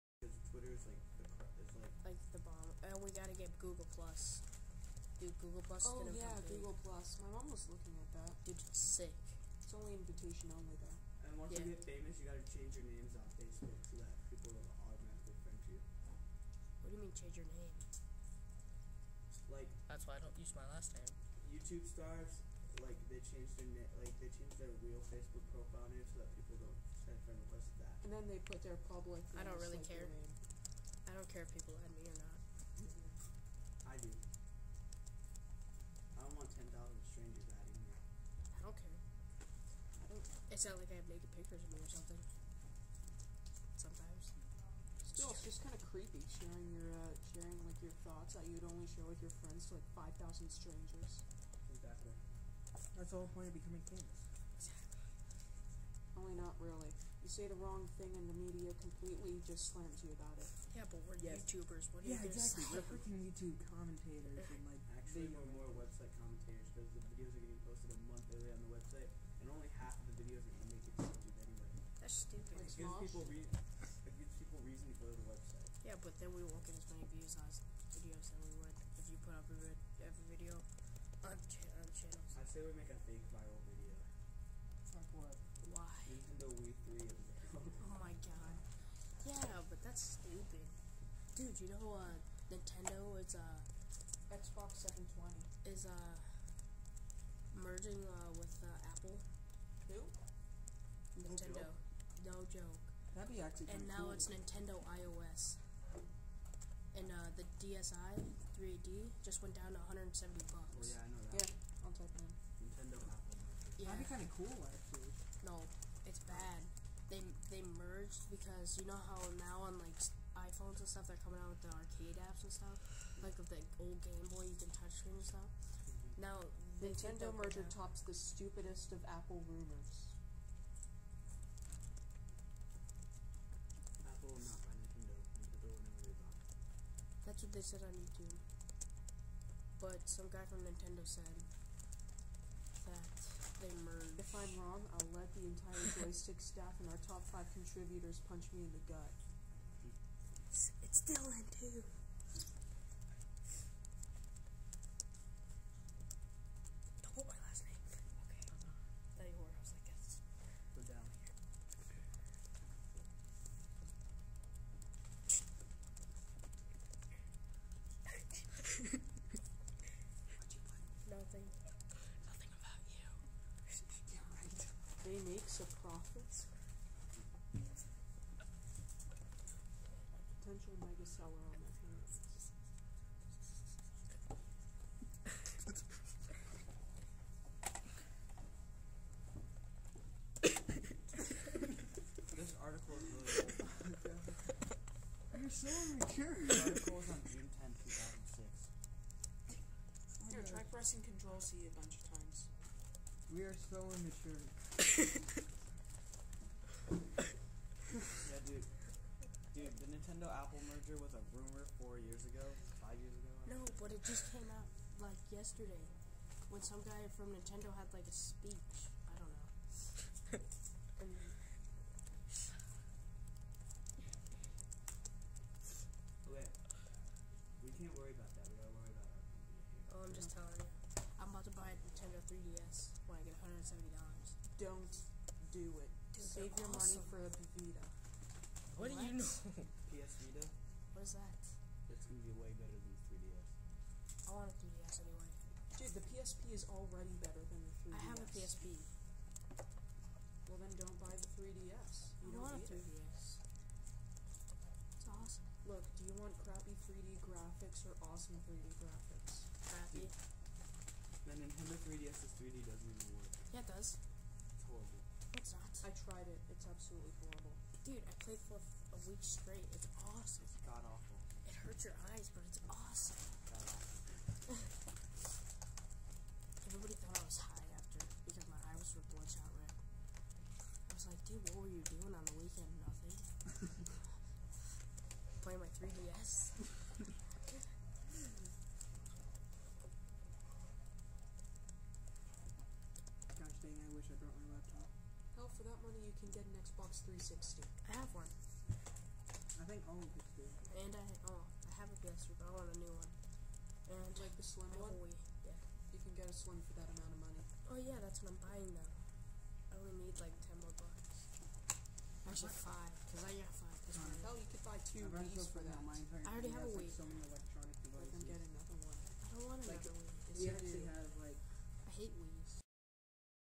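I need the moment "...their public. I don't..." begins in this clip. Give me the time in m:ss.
0:28.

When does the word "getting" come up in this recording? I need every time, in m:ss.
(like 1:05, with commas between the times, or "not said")
1:07, 5:18.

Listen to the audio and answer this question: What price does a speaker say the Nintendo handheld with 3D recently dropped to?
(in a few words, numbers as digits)
$170.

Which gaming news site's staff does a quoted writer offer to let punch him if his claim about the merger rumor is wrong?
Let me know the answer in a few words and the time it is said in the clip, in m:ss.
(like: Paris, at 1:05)
Joystiq, at 2:26.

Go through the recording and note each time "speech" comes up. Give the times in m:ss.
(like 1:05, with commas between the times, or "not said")
3:38.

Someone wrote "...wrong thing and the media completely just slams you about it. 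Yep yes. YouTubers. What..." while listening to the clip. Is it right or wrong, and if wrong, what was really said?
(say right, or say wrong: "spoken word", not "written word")
right.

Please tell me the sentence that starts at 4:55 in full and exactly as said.
Hell, oh, for that money, you can get an Xbox 360.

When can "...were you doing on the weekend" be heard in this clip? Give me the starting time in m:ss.
4:41.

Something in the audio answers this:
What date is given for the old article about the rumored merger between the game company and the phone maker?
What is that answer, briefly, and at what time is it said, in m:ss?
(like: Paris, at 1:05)
June 10, 2006, at 3:17.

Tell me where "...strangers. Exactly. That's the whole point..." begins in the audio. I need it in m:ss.
0:50.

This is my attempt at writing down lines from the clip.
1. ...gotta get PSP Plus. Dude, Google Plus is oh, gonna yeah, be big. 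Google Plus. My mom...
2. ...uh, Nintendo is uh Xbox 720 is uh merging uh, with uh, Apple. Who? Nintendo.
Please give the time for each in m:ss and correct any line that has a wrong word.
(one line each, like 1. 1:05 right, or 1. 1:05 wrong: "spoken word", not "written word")
1. 0:03 wrong: "Google", not "PSP"
2. 1:31 right.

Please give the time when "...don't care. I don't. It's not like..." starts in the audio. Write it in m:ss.
0:38.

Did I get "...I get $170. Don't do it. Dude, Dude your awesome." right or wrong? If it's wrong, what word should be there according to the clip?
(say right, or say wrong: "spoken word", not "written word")
wrong: "Save", not "Dude".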